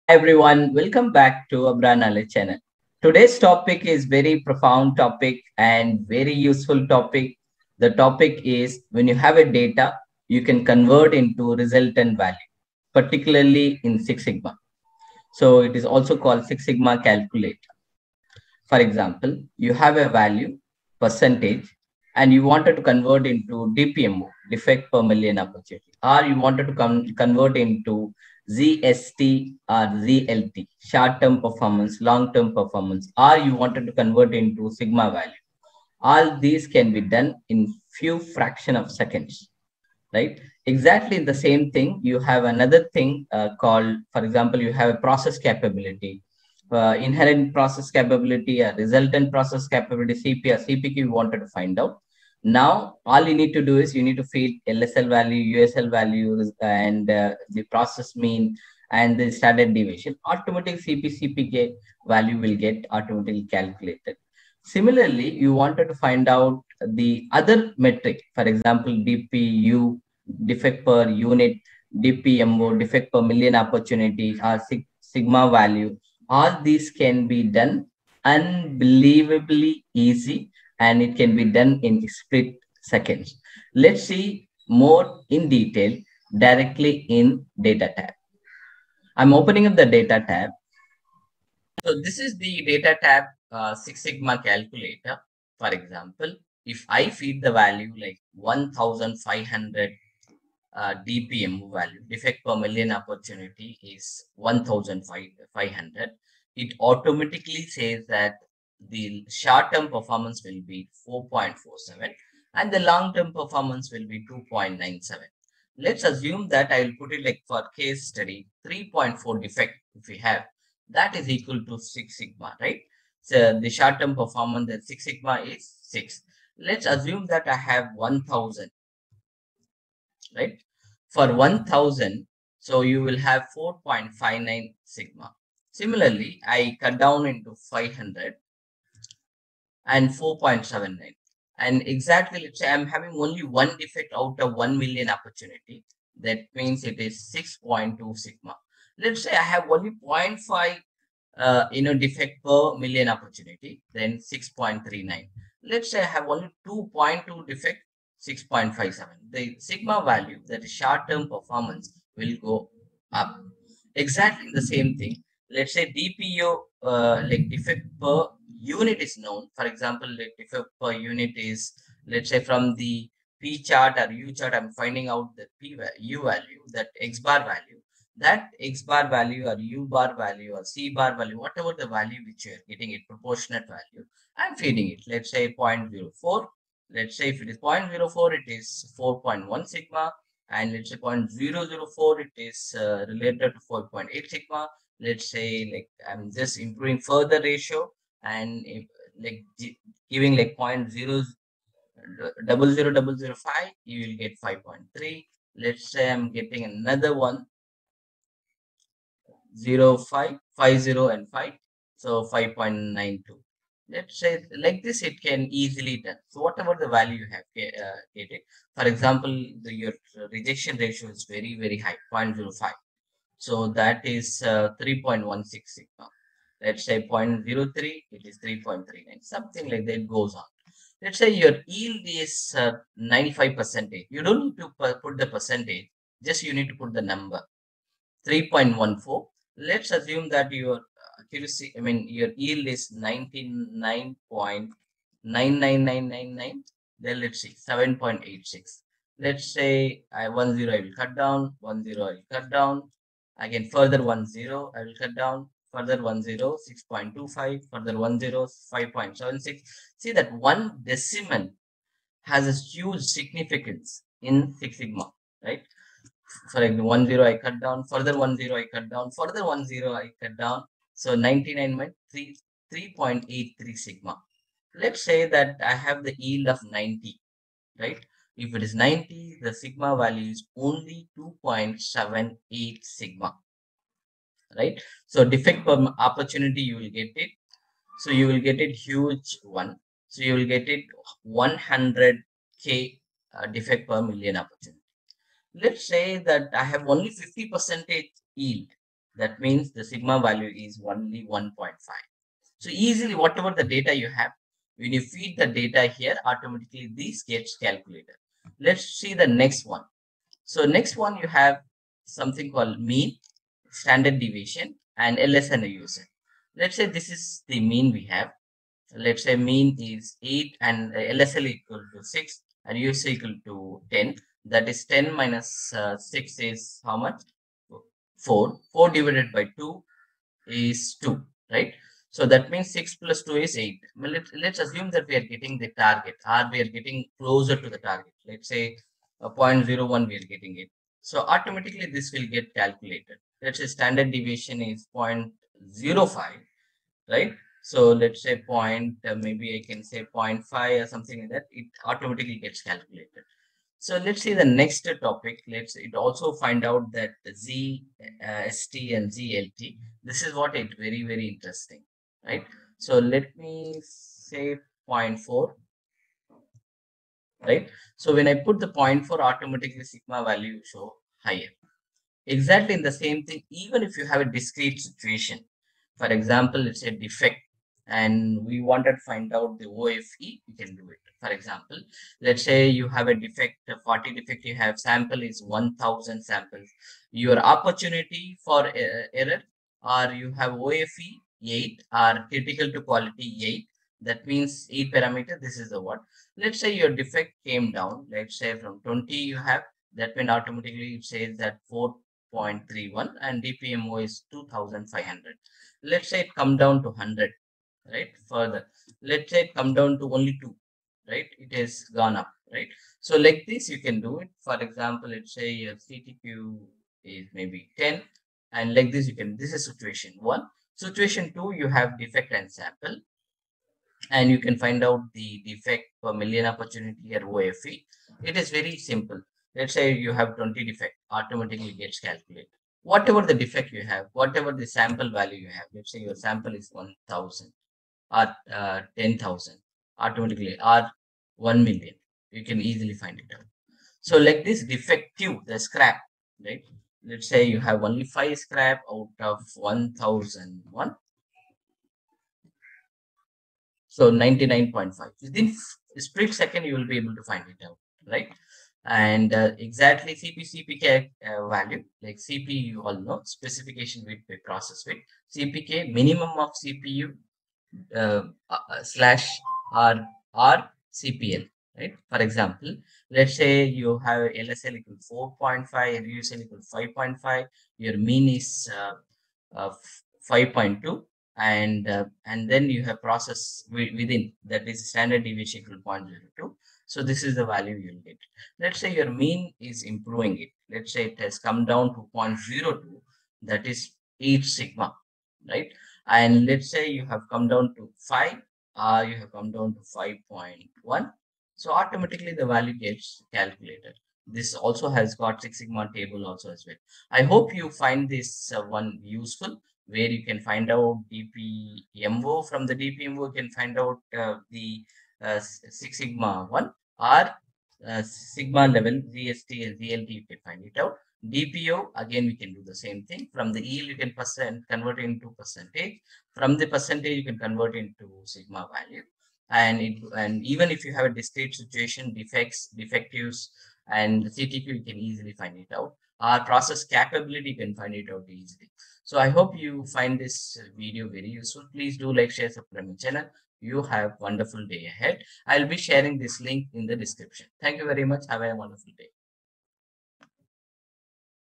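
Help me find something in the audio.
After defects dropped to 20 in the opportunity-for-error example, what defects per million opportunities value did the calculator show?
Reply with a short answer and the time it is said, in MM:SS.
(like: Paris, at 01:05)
2500, at 06:44.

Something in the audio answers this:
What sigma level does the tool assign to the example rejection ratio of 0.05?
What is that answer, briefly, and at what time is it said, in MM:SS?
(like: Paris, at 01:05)
3.16, at 03:44.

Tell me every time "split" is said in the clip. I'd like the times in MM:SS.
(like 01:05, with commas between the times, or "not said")
01:22, 07:36.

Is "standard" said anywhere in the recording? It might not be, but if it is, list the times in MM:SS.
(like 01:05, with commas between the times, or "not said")
00:59, 05:13, 05:43, 08:04.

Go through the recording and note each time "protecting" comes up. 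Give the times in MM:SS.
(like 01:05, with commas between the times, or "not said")
not said.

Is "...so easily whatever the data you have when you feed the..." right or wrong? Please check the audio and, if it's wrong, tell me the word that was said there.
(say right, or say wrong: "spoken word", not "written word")
right.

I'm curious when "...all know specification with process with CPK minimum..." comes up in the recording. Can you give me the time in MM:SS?
07:42.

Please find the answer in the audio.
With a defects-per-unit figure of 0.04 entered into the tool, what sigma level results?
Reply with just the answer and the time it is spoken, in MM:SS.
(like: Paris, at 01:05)
4.1 sigma, at 03:08.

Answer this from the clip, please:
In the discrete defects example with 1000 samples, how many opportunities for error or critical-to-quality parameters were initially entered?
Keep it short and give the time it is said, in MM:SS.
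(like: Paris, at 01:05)
8, at 06:30.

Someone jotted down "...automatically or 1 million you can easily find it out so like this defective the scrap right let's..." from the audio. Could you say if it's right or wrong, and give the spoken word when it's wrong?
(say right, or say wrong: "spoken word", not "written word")
right.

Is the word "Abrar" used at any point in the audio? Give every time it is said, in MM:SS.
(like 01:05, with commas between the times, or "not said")
00:01.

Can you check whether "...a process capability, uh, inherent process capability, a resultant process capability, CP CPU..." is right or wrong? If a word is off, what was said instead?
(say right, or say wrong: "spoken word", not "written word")
wrong: "CPK", not "CPU".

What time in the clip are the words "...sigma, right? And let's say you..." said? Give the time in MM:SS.
08:14.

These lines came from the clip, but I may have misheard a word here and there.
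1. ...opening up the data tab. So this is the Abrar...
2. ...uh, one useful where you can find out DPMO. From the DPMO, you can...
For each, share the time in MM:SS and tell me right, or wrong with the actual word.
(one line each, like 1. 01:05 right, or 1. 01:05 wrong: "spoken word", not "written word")
1. 01:29 wrong: "DATAtab", not "Abrar"
2. 08:28 right.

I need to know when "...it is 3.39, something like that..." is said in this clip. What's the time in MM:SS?
03:48.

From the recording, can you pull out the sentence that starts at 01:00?
Automatic CPCPK value will get automatically calculated.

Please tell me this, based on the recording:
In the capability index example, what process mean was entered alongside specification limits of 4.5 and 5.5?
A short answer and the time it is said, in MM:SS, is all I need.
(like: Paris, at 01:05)
5.2, at 08:00.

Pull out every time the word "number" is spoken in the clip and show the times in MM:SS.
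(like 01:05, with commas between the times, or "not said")
03:57.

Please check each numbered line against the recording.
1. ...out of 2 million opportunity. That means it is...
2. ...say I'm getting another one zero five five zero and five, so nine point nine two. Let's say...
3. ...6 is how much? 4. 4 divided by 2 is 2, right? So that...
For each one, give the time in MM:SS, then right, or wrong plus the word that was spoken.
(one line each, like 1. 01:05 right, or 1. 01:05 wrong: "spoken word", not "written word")
1. 02:24 wrong: "1", not "2"
2. 03:25 wrong: "five", not "nine"
3. 05:25 right.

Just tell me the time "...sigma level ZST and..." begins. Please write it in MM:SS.
08:38.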